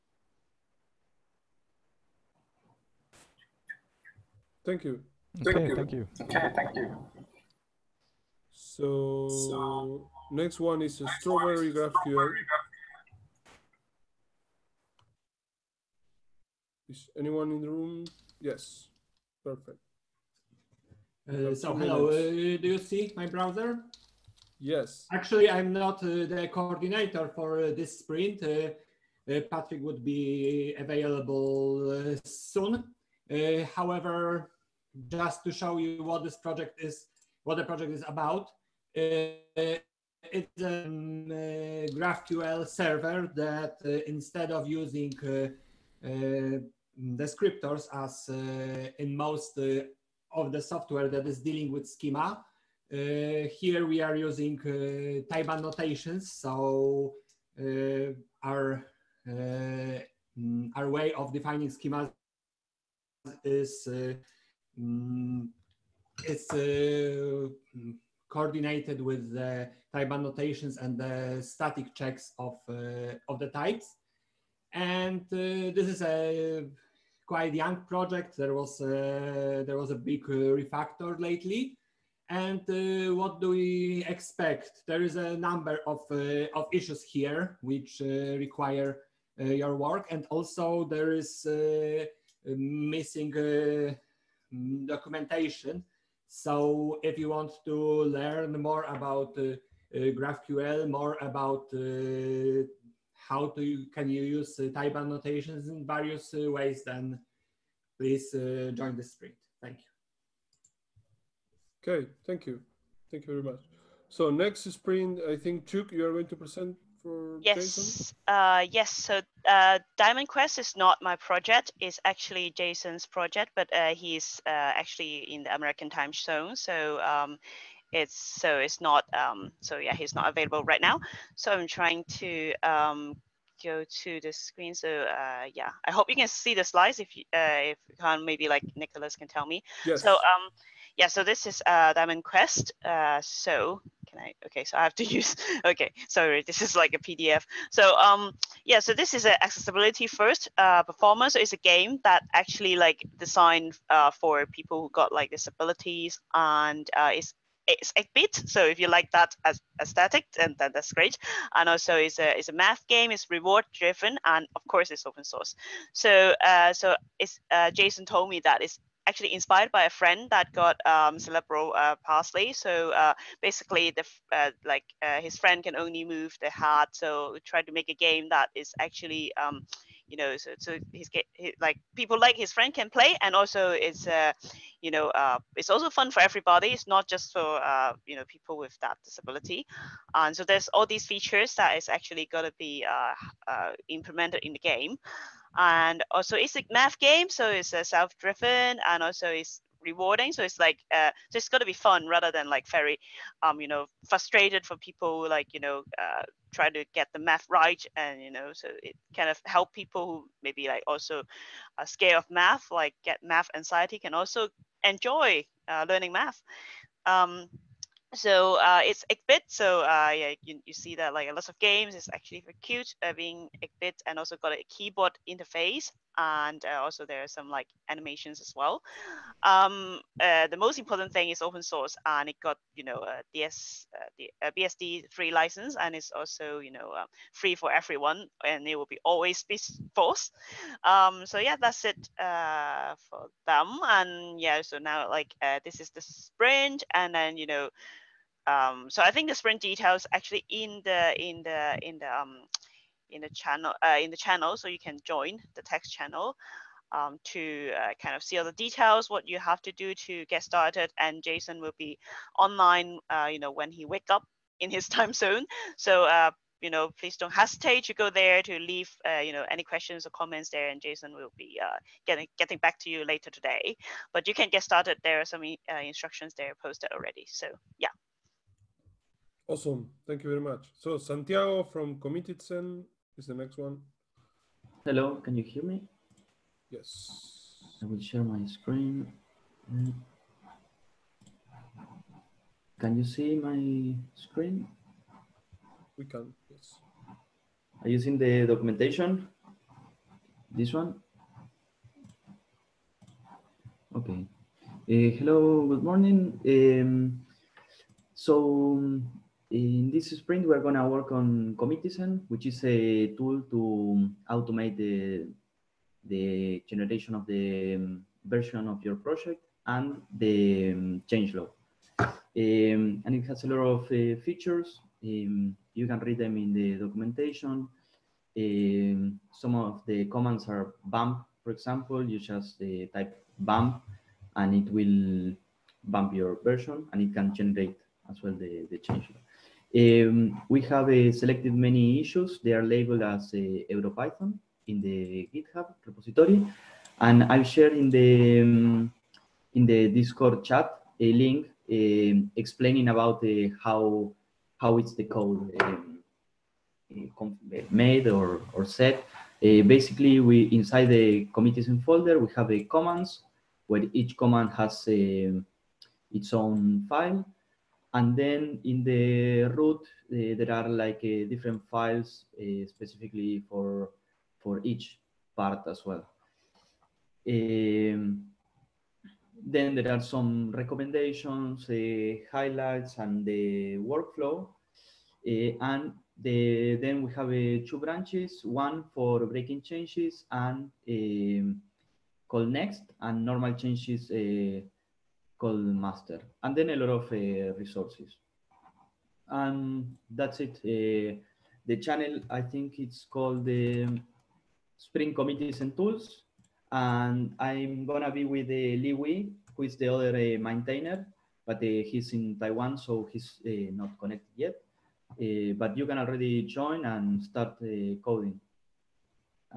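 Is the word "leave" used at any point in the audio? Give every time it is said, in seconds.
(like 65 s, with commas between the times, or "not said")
268 s.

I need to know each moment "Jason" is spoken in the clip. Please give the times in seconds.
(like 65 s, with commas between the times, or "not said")
122 s, 167 s, 261 s, 270 s.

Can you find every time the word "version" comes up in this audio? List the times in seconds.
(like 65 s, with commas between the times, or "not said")
318 s, 336 s.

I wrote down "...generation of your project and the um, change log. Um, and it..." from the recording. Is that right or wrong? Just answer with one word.
wrong.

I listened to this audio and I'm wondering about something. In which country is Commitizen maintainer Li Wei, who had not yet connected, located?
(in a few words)
Taiwan.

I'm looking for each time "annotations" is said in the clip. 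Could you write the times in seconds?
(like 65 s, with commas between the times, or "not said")
55 s, 69 s, 104 s.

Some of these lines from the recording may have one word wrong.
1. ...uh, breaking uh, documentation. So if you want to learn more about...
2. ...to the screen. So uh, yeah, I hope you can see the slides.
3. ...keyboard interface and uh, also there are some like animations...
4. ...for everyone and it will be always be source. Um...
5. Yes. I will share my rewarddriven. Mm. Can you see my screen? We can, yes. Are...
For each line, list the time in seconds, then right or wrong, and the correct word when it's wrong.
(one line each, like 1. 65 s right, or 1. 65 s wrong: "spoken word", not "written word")
1. 91 s wrong: "missing", not "breaking"
2. 134 s right
3. 224 s right
4. 237 s wrong: "force", not "source"
5. 286 s wrong: "screen", not "rewarddriven".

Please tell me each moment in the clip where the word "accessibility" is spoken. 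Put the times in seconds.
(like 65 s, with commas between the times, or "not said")
149 s.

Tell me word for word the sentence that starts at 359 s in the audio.
Uh, basically, we inside the commitizen folder, we have the commands where each command has um, its own file.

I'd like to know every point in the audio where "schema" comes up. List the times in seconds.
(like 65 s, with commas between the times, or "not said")
51 s, 61 s.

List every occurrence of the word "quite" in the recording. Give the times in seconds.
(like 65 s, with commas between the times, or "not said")
77 s.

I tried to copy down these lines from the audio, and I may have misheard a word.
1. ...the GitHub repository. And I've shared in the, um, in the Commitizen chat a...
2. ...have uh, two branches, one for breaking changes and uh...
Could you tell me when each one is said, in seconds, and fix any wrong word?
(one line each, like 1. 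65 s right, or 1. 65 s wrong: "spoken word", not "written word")
1. 344 s wrong: "Discord", not "Commitizen"
2. 387 s right.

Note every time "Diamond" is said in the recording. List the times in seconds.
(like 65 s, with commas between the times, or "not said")
119 s, 141 s.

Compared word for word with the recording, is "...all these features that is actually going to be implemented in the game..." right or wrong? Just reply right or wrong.
right.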